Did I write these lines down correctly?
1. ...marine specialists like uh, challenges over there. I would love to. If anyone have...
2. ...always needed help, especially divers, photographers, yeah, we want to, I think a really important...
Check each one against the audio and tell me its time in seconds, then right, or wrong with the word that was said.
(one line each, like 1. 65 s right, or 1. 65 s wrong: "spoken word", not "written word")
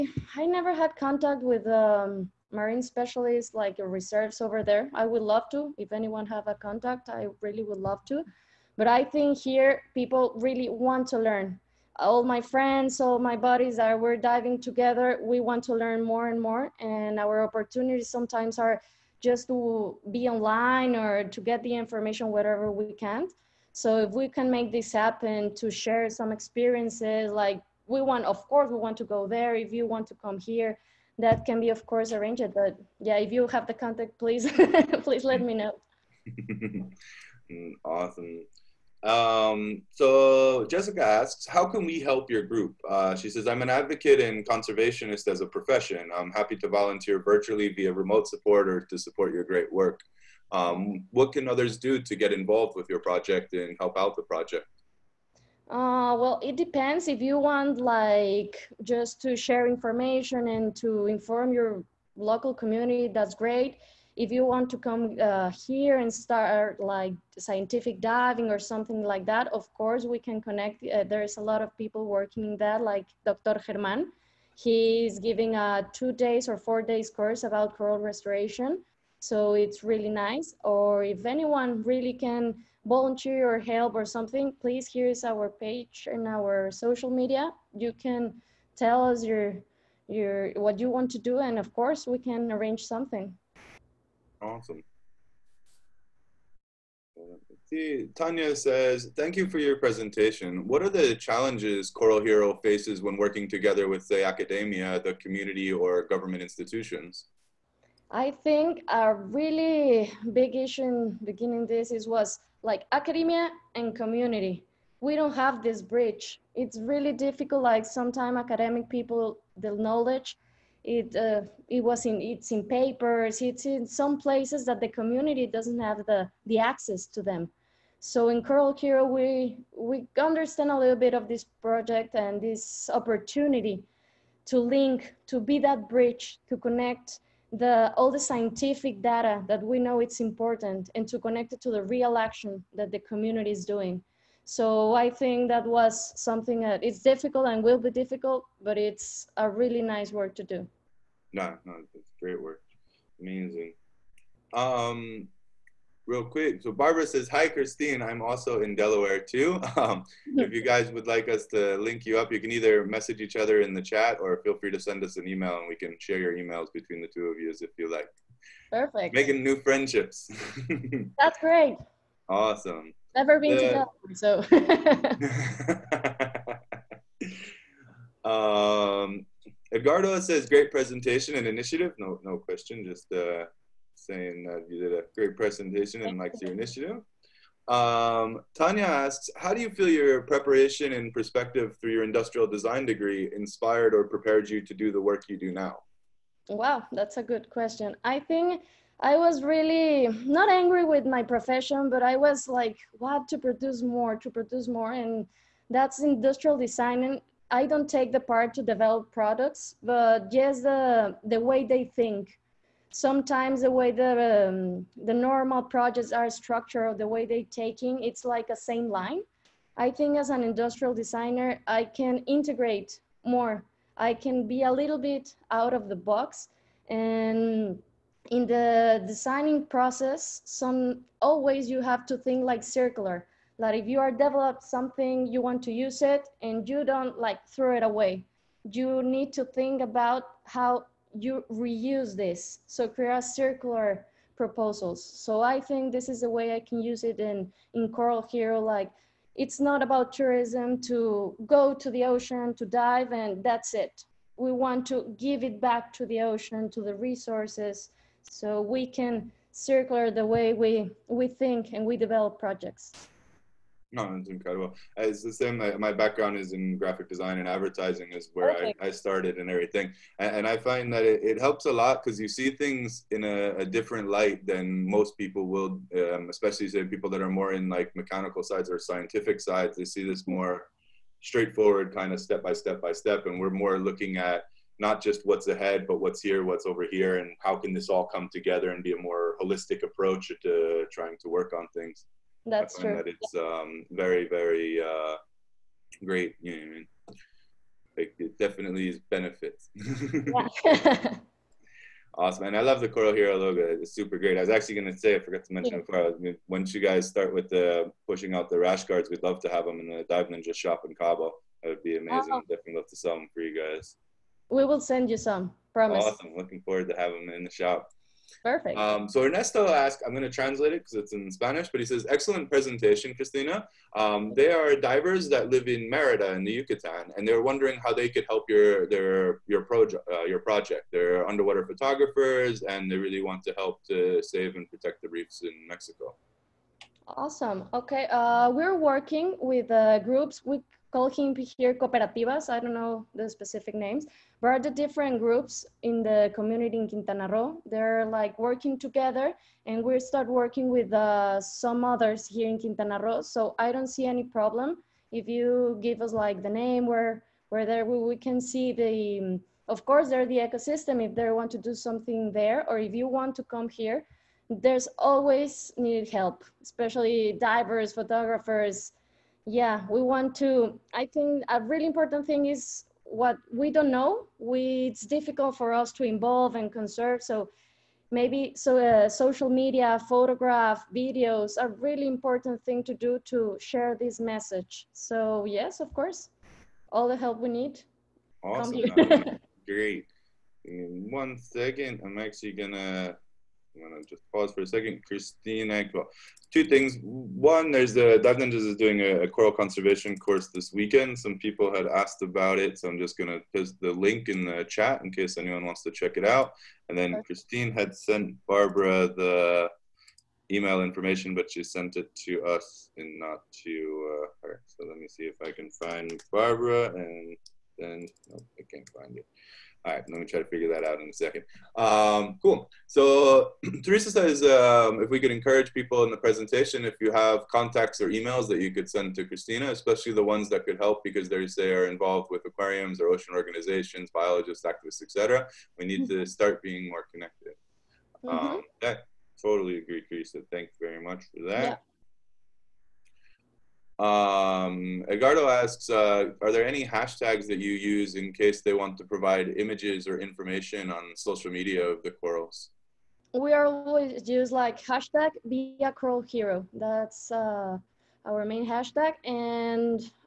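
1. 2 s wrong: "reserves", not "challenges"
2. 364 s right.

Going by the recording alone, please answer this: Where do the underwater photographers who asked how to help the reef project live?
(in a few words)
Merida.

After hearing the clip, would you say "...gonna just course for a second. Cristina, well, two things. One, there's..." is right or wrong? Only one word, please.
wrong.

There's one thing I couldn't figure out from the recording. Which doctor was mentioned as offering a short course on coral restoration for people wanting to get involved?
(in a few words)
Dr. Germán.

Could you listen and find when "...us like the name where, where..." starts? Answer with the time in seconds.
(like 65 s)
356 s.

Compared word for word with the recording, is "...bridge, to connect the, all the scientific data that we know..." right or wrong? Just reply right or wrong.
right.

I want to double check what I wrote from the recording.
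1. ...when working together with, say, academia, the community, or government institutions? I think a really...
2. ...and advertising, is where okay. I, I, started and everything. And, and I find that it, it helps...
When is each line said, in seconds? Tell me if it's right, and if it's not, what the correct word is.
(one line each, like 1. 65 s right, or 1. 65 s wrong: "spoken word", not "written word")
1. 103 s right
2. 267 s right.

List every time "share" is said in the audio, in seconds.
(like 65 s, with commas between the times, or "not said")
25 s, 59 s, 165 s, 383 s.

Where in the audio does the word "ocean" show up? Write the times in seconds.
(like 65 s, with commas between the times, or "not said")
252 s, 256 s, 433 s.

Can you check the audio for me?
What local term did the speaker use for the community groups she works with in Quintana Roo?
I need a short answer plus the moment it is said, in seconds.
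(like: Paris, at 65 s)
Cooperativas, at 341 s.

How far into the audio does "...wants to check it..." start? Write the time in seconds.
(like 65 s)
405 s.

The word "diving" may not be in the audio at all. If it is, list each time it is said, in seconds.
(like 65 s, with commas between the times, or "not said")
14 s, 67 s.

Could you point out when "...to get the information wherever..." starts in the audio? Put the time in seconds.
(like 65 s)
21 s.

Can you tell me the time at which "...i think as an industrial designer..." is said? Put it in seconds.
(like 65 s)
219 s.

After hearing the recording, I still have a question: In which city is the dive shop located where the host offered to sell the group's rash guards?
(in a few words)
Cabo.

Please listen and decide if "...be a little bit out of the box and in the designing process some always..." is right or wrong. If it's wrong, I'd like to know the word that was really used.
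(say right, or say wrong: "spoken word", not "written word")
right.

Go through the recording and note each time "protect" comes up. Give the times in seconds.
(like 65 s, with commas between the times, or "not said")
334 s.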